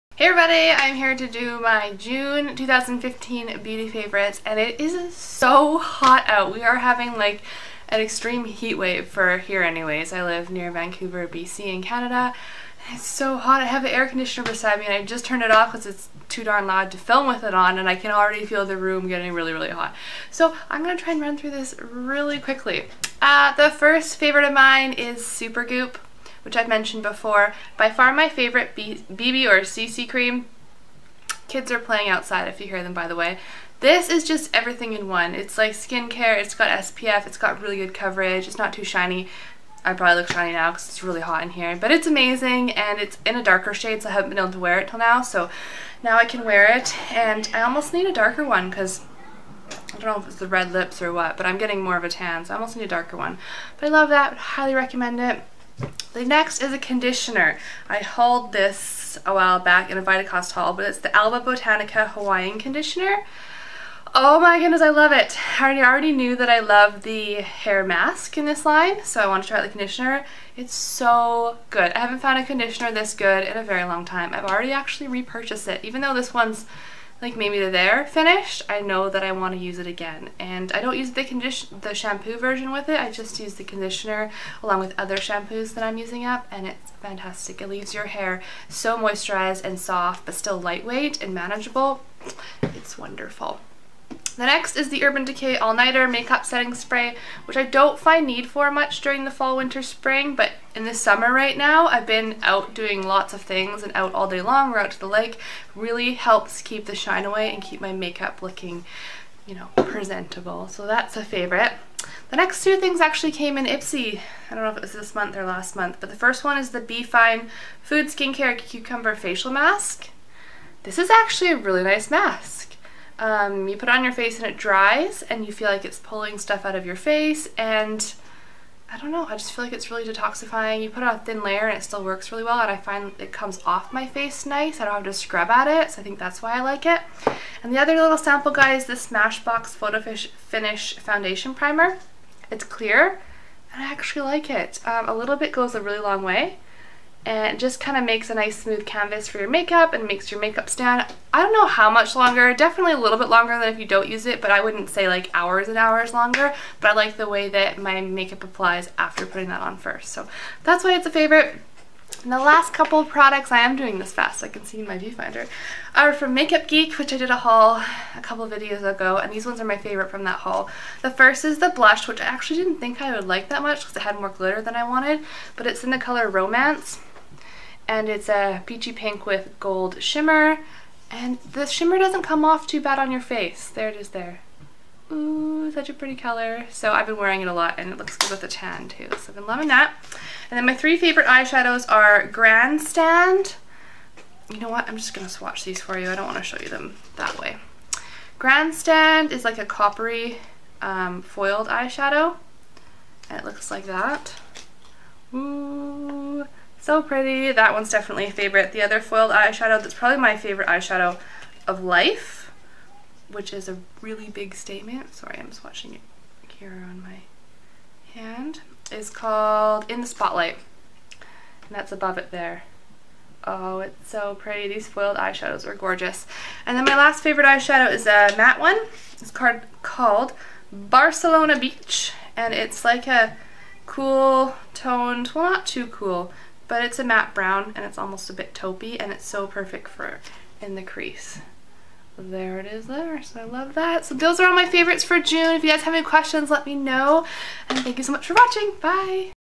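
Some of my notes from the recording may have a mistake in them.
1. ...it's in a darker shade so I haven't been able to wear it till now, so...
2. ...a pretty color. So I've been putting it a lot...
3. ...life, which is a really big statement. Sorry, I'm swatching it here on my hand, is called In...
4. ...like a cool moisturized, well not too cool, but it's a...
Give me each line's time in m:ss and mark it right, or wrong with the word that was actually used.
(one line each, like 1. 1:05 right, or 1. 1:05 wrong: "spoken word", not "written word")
1. 0:42 right
2. 3:05 wrong: "wearing", not "putting"
3. 3:31 right
4. 3:52 wrong: "toned", not "moisturized".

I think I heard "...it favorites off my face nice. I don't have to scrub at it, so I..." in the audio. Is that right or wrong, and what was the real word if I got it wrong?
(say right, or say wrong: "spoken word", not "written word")
wrong: "comes", not "favorites".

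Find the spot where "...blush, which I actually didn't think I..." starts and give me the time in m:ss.
2:51.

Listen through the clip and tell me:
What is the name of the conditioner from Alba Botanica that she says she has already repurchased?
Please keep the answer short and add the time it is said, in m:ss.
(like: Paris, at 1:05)
Hawaiian Conditioner, at 1:02.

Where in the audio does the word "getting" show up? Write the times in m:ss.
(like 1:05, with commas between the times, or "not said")
0:19, 0:51.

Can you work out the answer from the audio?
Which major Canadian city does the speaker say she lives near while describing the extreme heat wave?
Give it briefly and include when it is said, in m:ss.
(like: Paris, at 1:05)
Vancouver, at 0:10.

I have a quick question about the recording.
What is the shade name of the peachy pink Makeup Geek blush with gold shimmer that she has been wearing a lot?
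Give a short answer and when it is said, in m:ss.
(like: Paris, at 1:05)
Romance, at 2:56.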